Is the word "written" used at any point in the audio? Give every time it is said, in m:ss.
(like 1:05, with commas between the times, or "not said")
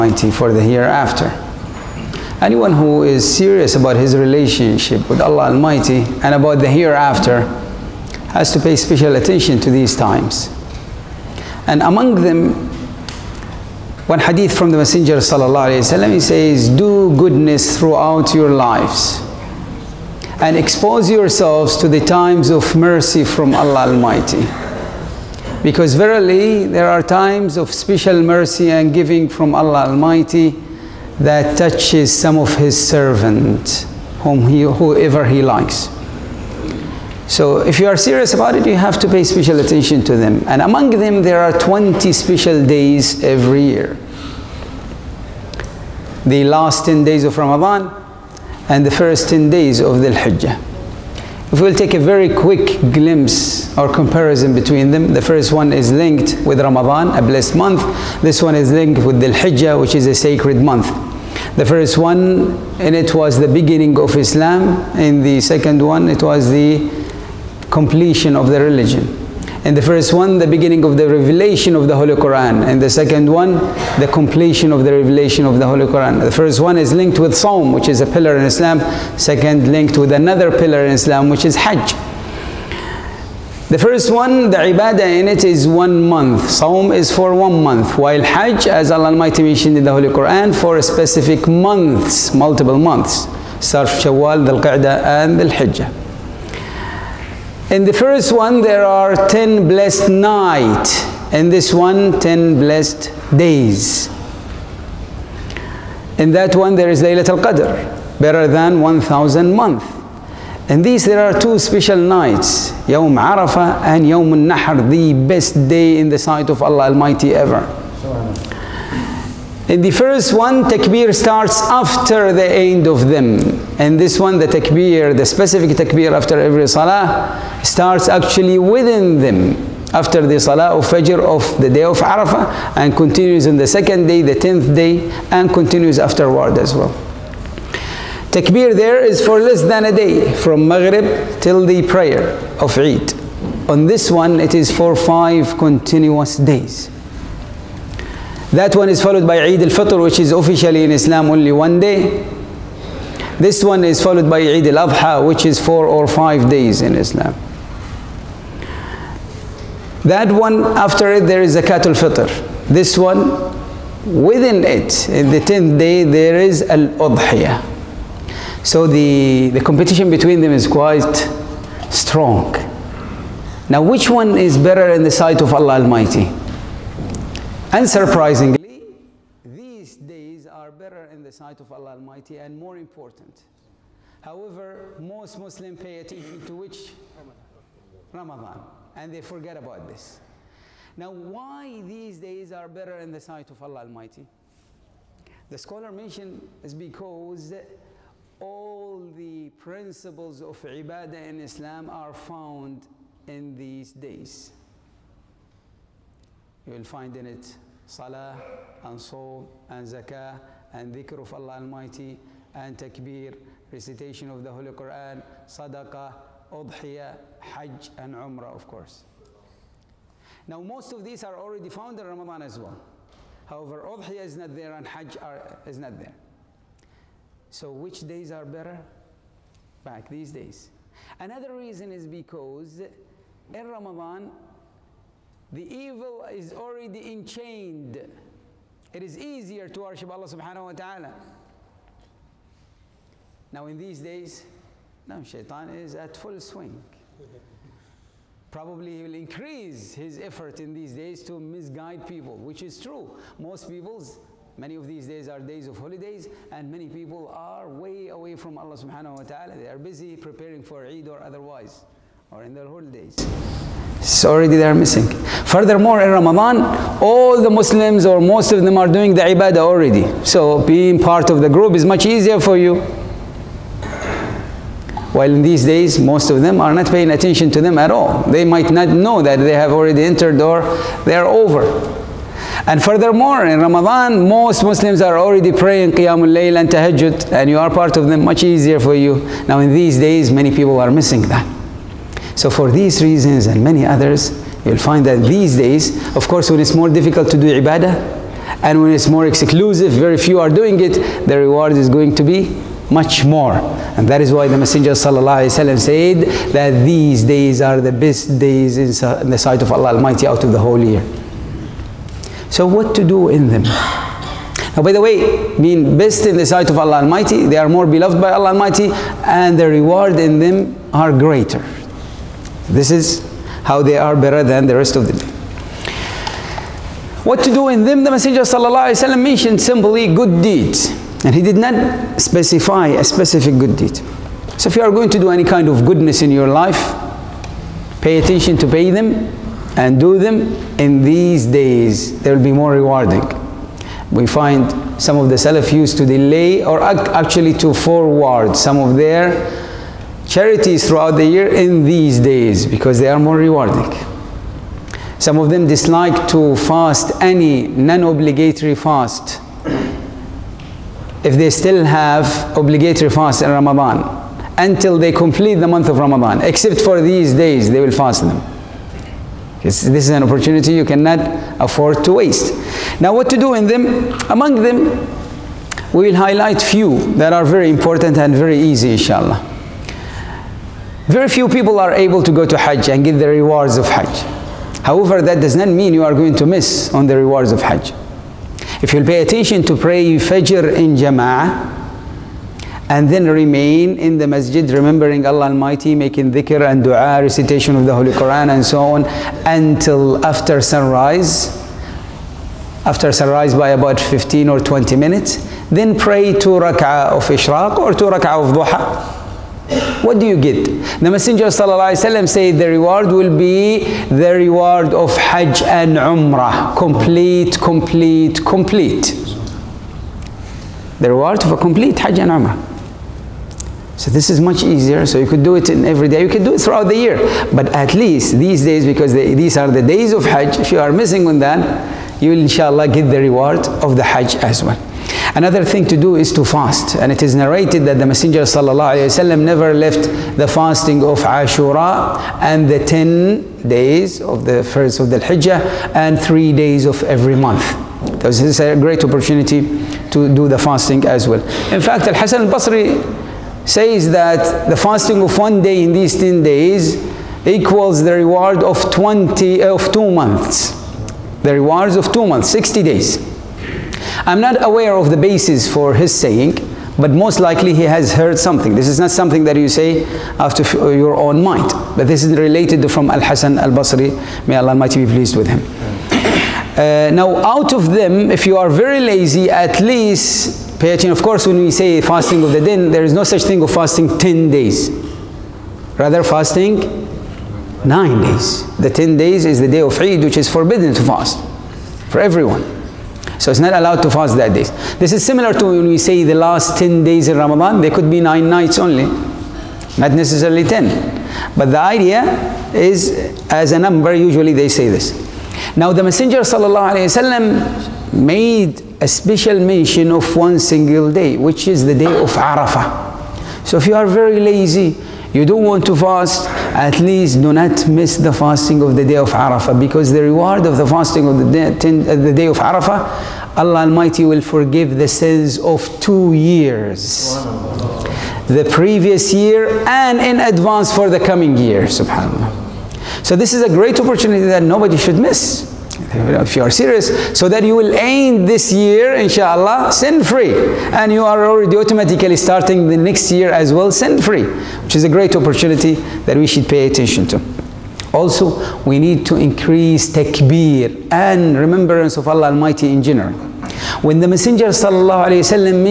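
not said.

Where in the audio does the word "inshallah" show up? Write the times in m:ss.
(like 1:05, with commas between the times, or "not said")
6:18, 7:12, 8:59.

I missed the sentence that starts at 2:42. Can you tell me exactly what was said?
This one, within it, in the 10th day, there is al-Udhiyah.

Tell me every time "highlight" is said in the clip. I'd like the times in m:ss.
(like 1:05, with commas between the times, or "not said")
6:16.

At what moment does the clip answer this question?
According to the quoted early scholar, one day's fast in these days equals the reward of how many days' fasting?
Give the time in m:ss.
7:42.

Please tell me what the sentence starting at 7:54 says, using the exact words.
May Allah Almighty be pleased with him.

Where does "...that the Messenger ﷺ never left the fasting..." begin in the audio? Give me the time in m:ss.
7:17.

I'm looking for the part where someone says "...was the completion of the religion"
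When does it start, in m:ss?
1:06.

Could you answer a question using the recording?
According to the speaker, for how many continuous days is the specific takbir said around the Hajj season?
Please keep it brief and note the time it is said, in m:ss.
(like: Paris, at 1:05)
5, at 2:24.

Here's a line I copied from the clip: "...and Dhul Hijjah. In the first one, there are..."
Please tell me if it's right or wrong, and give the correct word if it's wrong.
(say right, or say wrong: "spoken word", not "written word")
right.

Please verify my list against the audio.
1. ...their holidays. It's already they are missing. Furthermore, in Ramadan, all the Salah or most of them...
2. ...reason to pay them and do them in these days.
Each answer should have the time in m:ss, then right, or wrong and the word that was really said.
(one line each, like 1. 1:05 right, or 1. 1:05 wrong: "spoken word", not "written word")
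1. 4:22 wrong: "Muslims", not "Salah"
2. 5:38 wrong: "attention", not "reason".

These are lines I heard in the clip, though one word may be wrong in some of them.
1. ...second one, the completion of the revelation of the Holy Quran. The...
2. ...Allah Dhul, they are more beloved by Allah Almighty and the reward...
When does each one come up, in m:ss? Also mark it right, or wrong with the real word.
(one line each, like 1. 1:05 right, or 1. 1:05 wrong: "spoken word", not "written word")
1. 1:12 right
2. 5:16 wrong: "Almighty", not "Dhul".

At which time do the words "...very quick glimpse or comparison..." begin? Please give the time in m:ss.
0:51.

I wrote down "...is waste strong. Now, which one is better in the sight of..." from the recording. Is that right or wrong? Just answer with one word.
wrong.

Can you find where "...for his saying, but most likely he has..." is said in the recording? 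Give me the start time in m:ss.
7:45.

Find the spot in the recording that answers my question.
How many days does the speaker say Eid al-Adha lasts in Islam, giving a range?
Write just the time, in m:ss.
2:35.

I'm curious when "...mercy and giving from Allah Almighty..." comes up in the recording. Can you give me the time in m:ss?
0:28.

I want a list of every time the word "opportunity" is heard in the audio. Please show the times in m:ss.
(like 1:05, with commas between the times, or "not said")
6:10, 7:29, 8:53, 9:05.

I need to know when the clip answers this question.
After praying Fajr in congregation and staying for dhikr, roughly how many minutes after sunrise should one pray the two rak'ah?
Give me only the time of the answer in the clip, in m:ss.
6:43.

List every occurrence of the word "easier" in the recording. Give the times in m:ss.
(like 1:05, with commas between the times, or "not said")
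3:59, 4:32, 4:48, 7:04.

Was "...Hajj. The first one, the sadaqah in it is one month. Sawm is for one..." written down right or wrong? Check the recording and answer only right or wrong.
wrong.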